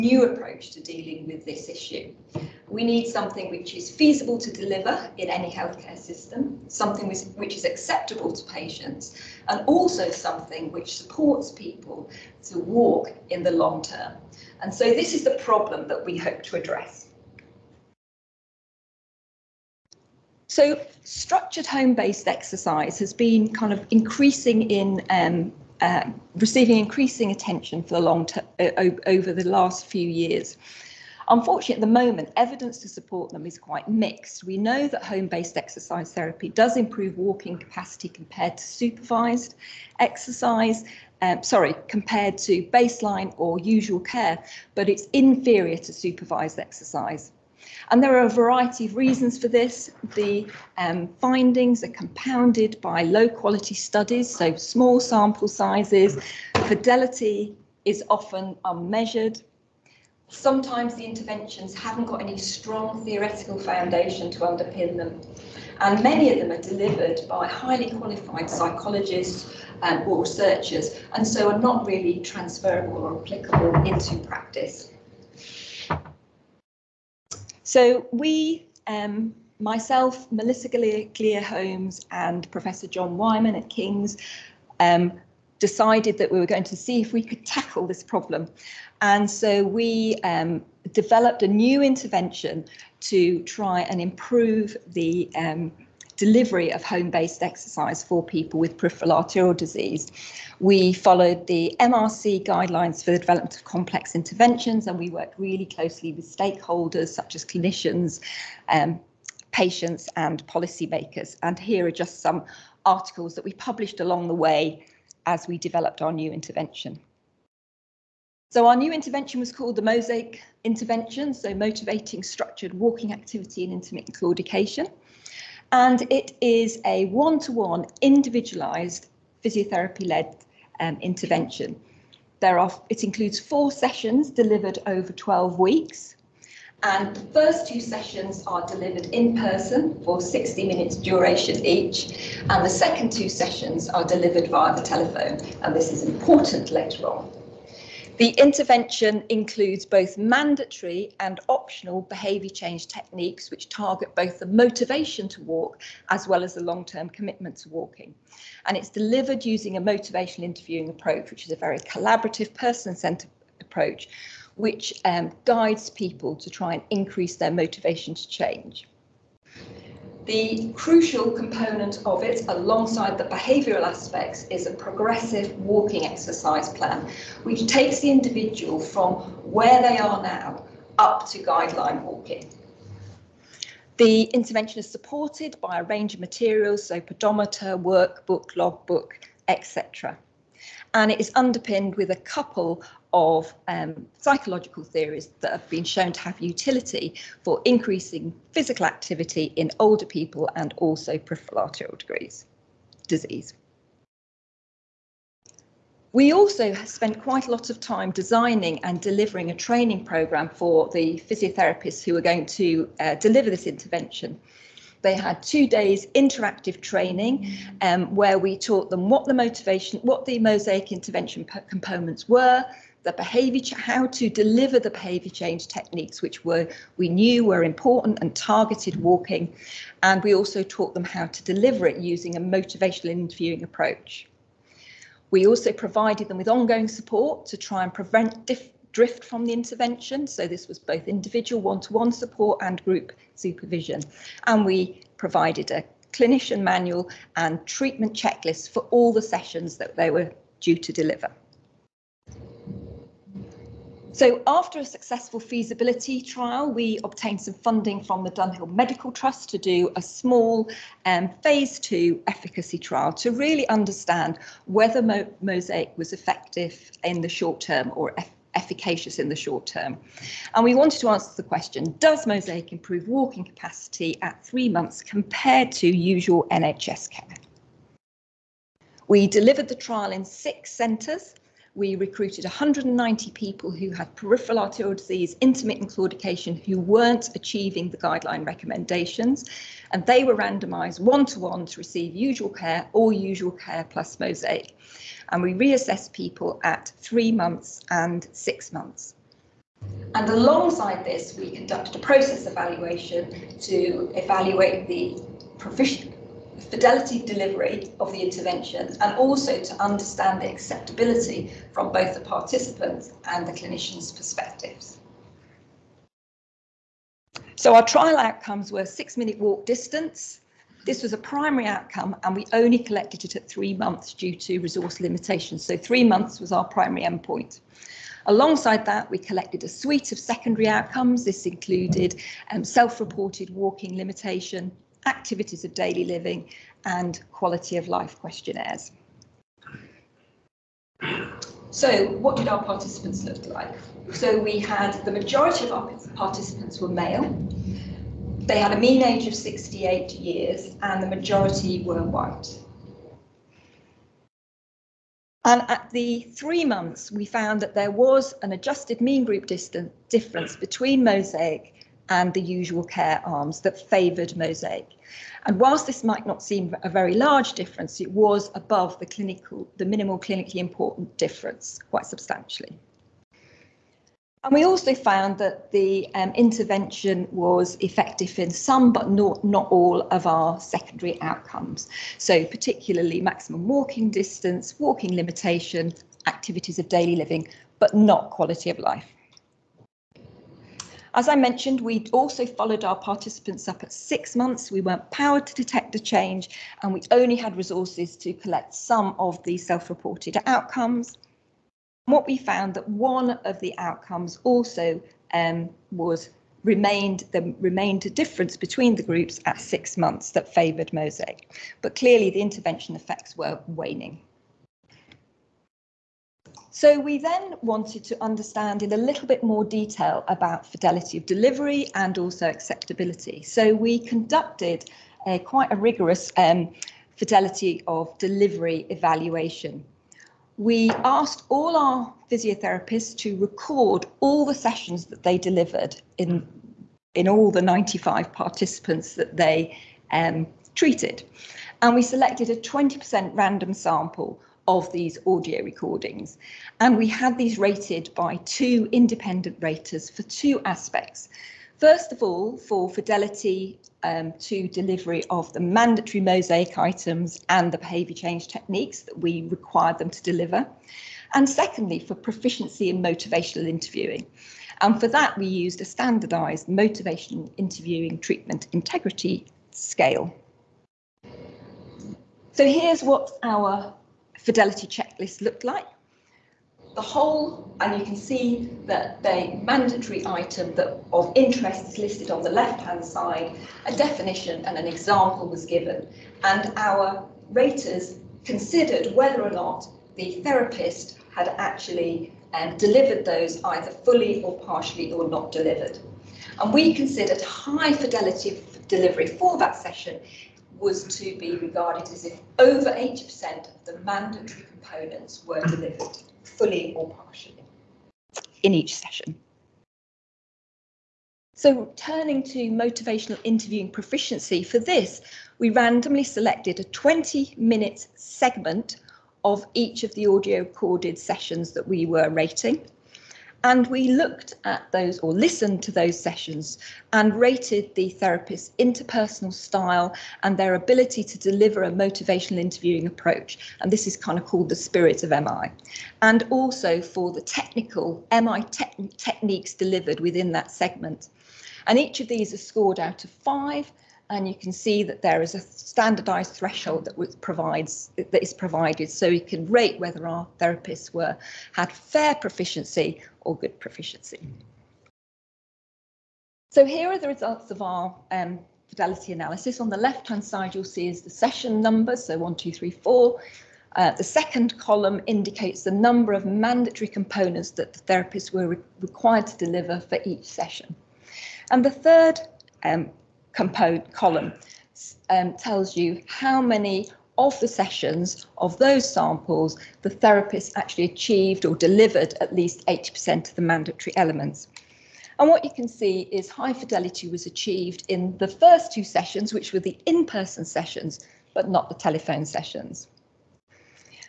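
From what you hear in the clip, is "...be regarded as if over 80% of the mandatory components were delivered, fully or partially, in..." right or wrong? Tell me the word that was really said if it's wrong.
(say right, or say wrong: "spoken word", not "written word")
right.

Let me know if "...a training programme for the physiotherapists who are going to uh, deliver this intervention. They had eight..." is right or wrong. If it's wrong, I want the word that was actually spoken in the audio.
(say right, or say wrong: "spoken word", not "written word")
wrong: "two", not "eight".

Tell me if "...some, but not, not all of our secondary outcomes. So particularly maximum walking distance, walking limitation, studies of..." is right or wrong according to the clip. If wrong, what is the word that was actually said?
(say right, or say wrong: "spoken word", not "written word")
wrong: "activities", not "studies".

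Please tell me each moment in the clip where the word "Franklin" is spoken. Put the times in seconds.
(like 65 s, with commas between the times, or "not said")
not said.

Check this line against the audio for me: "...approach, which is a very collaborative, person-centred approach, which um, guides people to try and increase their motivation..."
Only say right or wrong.
right.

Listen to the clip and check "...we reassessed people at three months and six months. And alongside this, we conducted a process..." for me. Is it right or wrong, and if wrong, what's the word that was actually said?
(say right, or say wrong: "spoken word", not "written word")
right.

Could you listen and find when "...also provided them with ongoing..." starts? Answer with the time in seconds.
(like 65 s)
235 s.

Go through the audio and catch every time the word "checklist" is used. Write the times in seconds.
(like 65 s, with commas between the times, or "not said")
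248 s, 474 s.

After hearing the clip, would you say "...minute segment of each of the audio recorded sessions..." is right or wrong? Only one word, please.
right.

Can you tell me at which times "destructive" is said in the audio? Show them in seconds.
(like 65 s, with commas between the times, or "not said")
not said.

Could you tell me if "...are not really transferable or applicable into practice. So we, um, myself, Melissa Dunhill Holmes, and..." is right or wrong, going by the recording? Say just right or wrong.
wrong.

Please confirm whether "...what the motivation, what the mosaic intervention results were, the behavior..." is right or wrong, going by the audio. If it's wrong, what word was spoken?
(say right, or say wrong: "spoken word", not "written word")
wrong: "components", not "results".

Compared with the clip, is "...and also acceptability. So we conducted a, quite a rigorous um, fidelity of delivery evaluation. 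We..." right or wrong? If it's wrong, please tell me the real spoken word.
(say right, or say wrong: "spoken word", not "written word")
right.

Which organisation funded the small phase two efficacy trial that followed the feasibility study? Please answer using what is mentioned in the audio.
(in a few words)
Dunhill Medical Trust.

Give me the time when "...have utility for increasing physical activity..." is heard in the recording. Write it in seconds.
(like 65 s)
196 s.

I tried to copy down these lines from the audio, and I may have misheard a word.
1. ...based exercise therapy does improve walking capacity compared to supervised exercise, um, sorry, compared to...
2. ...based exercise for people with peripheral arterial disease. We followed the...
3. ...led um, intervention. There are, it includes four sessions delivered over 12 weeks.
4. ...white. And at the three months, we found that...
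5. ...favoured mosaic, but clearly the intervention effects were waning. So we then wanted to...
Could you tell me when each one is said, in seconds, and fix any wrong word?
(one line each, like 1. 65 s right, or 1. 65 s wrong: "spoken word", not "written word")
1. 35 s right
2. 97 s right
3. 130 s right
4. 352 s right
5. 410 s right.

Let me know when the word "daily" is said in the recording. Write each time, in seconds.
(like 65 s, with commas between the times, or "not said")
335 s, 386 s.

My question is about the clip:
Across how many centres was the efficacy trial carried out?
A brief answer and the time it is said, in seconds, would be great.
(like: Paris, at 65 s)
6, at 280 s.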